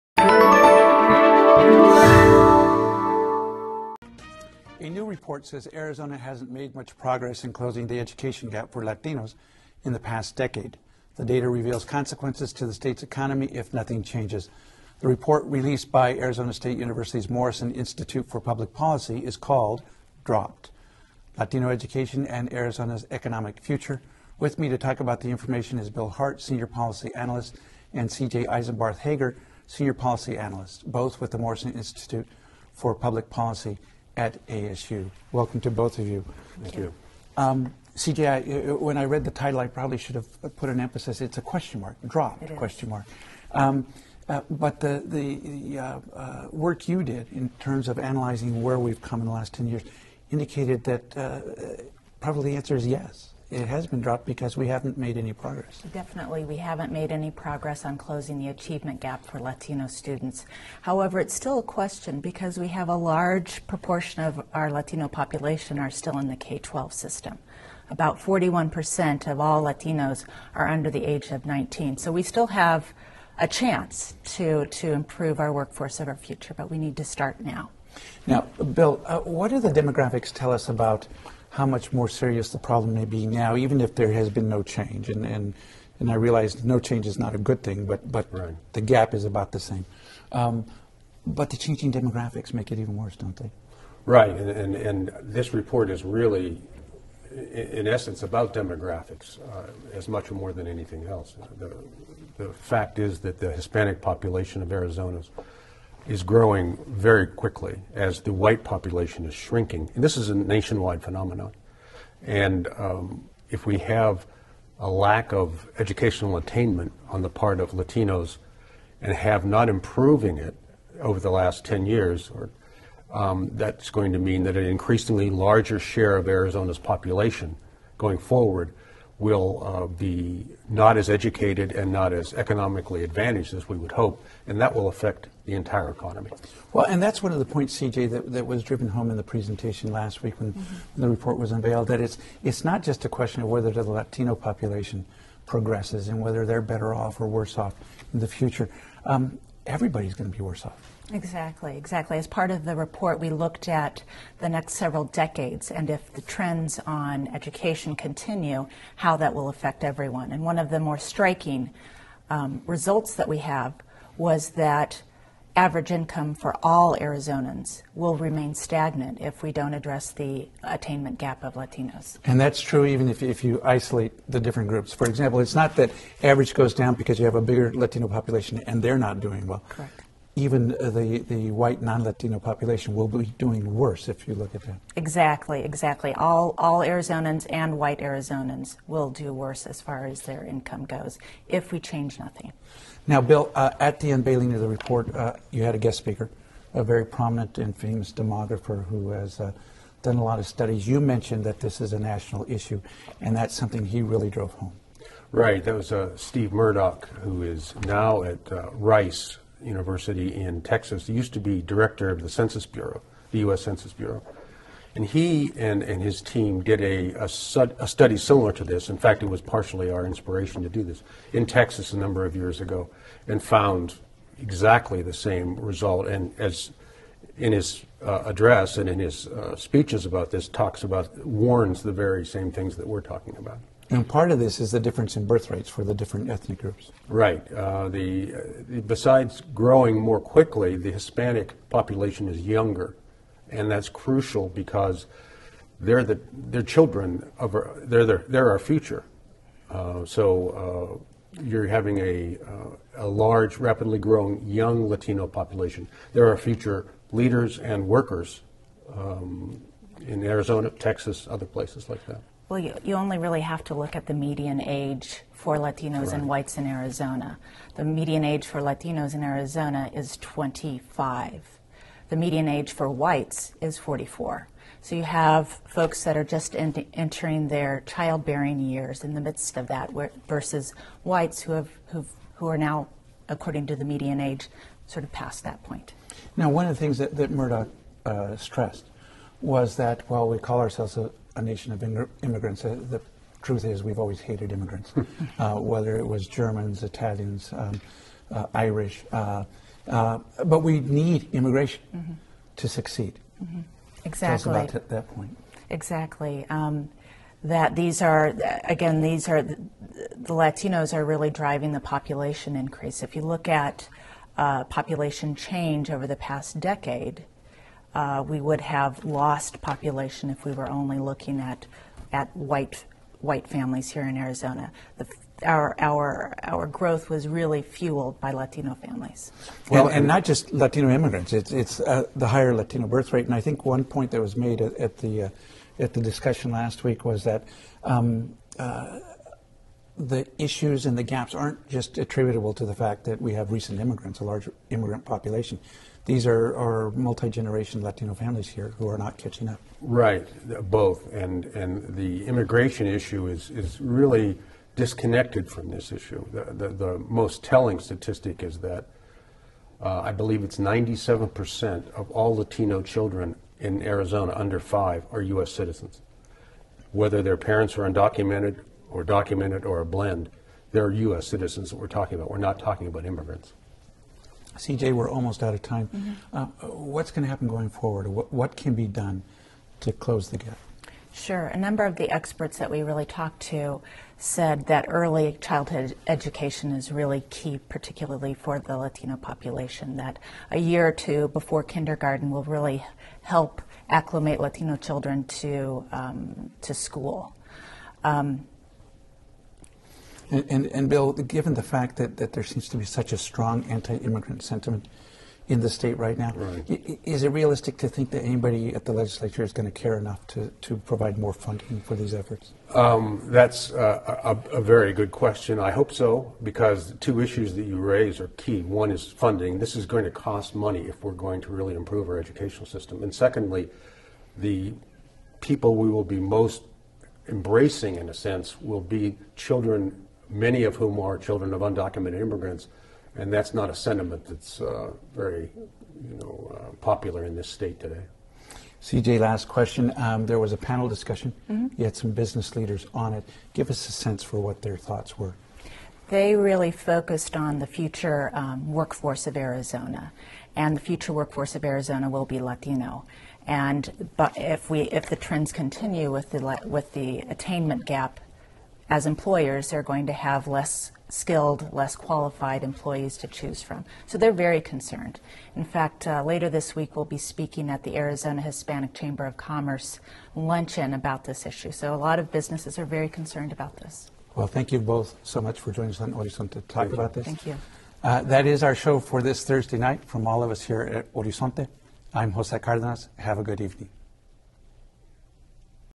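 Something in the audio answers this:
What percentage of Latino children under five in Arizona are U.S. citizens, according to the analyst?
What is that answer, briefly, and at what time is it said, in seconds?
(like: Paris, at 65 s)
97%, at 360 s.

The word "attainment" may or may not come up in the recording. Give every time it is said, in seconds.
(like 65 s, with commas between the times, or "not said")
116 s, 170 s, 457 s.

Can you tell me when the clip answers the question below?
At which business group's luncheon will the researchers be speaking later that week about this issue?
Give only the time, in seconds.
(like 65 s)
467 s.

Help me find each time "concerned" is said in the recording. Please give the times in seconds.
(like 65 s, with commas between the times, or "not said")
464 s, 473 s.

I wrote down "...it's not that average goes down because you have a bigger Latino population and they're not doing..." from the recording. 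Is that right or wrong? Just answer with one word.
right.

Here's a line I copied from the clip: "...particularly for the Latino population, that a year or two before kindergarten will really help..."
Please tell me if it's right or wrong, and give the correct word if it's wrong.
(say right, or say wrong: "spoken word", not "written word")
right.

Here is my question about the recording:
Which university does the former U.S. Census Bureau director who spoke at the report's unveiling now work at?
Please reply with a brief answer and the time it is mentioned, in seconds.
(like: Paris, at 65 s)
Rice University, at 208 s.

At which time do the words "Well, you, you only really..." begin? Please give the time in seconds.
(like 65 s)
262 s.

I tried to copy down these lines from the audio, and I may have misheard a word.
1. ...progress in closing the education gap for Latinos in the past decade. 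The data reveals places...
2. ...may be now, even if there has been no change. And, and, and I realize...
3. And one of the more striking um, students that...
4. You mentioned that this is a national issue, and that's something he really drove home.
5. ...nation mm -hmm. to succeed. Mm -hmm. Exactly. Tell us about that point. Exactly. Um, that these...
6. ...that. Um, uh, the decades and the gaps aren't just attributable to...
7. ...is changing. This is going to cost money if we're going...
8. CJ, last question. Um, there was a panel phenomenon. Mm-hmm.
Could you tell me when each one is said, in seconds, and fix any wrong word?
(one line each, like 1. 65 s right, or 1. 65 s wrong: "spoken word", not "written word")
1. 6 s wrong: "consequences", not "places"
2. 82 s right
3. 160 s wrong: "results", not "students"
4. 200 s right
5. 301 s wrong: "immigration", not "nation"
6. 337 s wrong: "issues", not "decades"
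7. 418 s wrong: "funding", not "changing"
8. 438 s wrong: "discussion", not "phenomenon".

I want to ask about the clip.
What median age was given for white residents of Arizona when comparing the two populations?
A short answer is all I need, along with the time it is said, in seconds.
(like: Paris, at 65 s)
44, at 273 s.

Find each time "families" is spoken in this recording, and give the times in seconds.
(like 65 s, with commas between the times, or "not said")
323 s, 328 s, 348 s.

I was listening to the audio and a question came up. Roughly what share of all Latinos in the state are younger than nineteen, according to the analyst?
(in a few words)
41%.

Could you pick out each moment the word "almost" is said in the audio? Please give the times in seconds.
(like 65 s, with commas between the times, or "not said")
375 s.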